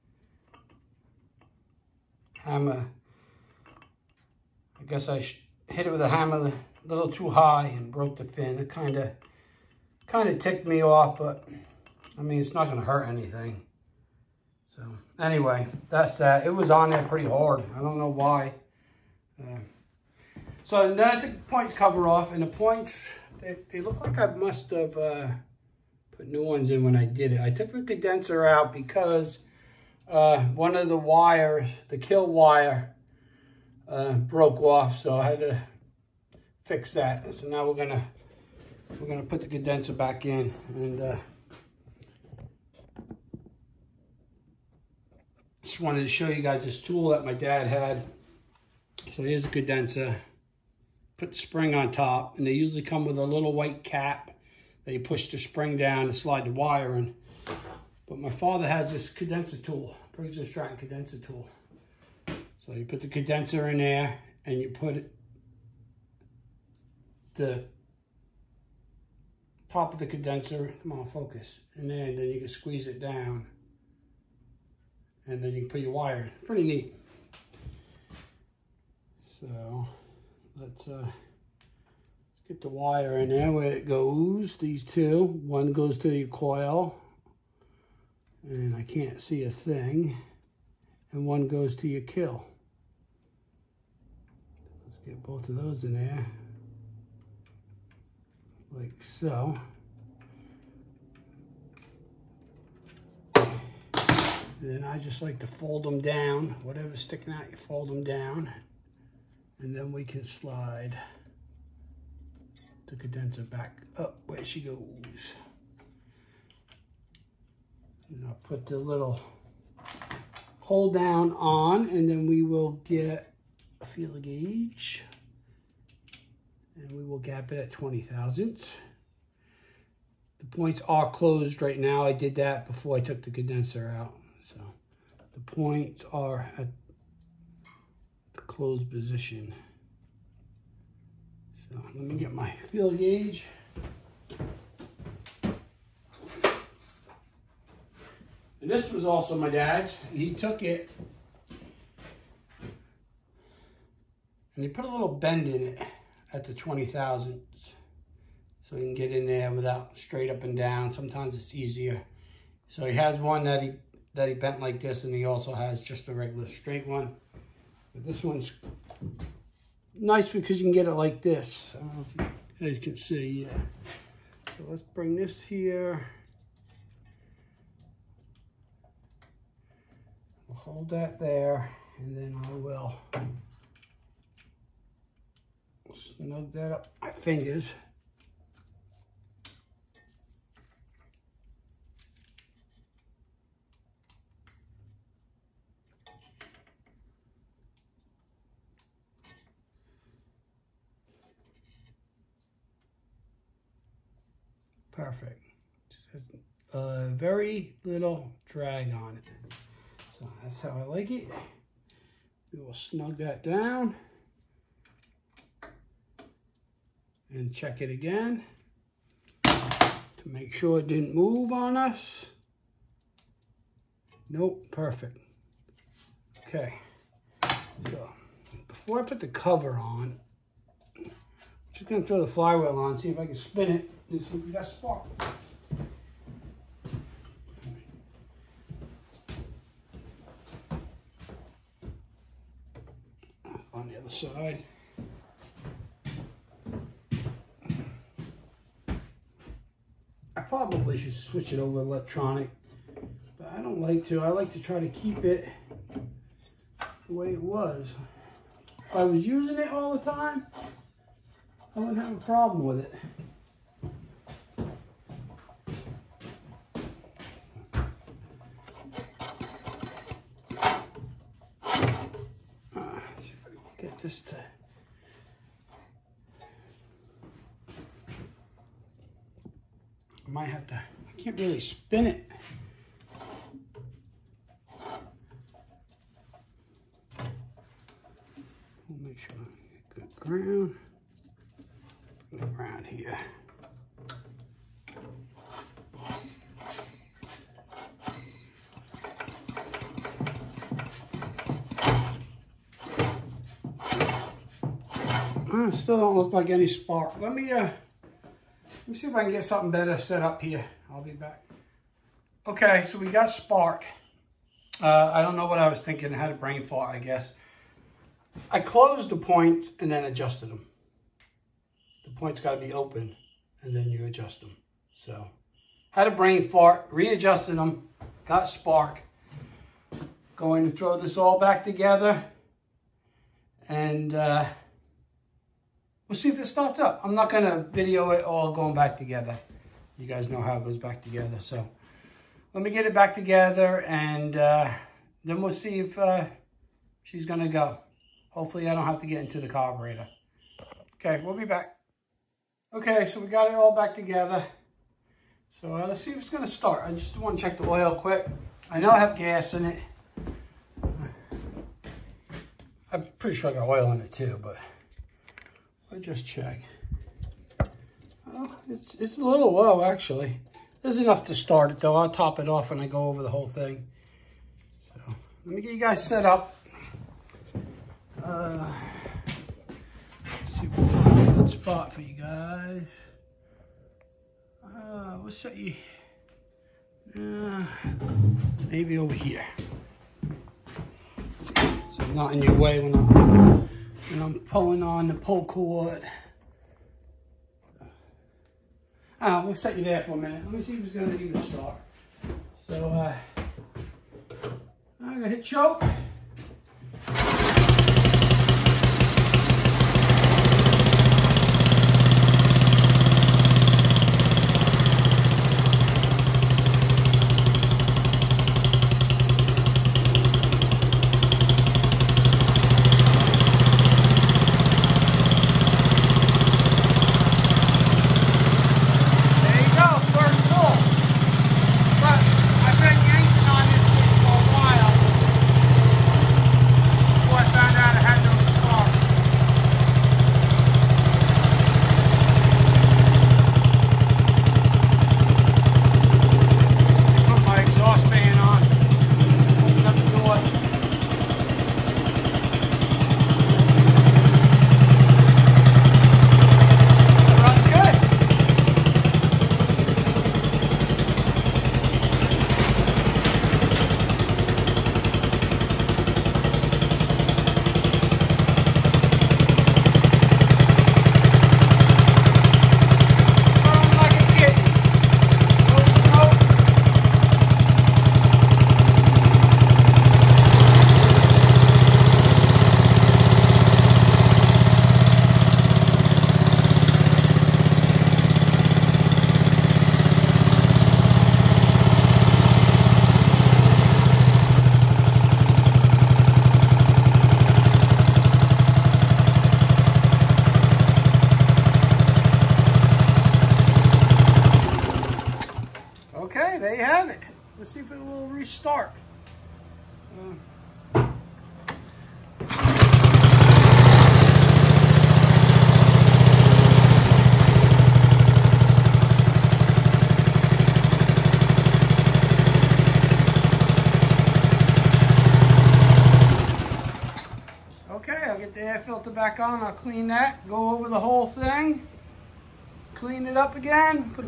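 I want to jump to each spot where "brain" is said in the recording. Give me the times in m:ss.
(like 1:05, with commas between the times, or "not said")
5:16, 5:26.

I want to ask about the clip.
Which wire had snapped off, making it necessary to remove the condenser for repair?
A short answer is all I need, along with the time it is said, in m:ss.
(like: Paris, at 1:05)
kill wire, at 0:31.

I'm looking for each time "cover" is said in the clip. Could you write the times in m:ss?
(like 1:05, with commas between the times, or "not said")
0:21, 3:49.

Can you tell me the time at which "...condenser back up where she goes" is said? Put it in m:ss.
1:52.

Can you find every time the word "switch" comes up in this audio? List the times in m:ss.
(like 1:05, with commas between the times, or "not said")
4:11.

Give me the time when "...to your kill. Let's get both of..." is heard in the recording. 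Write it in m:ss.
1:31.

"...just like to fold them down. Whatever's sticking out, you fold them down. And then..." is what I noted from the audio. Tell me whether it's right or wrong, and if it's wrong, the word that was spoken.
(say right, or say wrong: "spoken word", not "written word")
right.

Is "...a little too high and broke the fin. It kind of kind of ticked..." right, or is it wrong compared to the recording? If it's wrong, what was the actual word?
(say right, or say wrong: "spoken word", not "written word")
right.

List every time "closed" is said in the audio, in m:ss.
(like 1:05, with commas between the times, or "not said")
2:11, 2:18, 5:18.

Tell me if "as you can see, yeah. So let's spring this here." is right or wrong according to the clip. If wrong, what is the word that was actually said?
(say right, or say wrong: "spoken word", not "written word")
wrong: "bring", not "spring".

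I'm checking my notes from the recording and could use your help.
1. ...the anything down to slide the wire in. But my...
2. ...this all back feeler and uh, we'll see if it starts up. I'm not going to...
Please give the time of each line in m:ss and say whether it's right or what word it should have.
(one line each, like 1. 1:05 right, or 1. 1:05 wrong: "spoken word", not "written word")
1. 0:55 wrong: "spring", not "anything"
2. 5:30 wrong: "together", not "feeler".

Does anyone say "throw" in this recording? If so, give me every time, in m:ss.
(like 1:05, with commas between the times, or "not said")
3:52, 5:30.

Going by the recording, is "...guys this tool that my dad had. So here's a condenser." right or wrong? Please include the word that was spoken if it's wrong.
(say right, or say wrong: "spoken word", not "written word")
right.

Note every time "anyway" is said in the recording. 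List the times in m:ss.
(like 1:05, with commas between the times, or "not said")
0:15.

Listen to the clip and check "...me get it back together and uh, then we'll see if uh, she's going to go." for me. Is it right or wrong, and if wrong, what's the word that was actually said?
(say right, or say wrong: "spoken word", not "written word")
right.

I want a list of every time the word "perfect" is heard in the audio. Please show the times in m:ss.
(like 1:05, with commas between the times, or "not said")
3:24, 3:44.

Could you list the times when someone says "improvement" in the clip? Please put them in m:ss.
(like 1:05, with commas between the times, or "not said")
not said.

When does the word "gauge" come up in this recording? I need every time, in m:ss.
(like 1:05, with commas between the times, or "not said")
2:04, 2:22.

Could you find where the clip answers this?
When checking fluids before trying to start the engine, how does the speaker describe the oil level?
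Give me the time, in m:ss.
6:09.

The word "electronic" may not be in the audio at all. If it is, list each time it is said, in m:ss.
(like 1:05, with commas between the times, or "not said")
4:11.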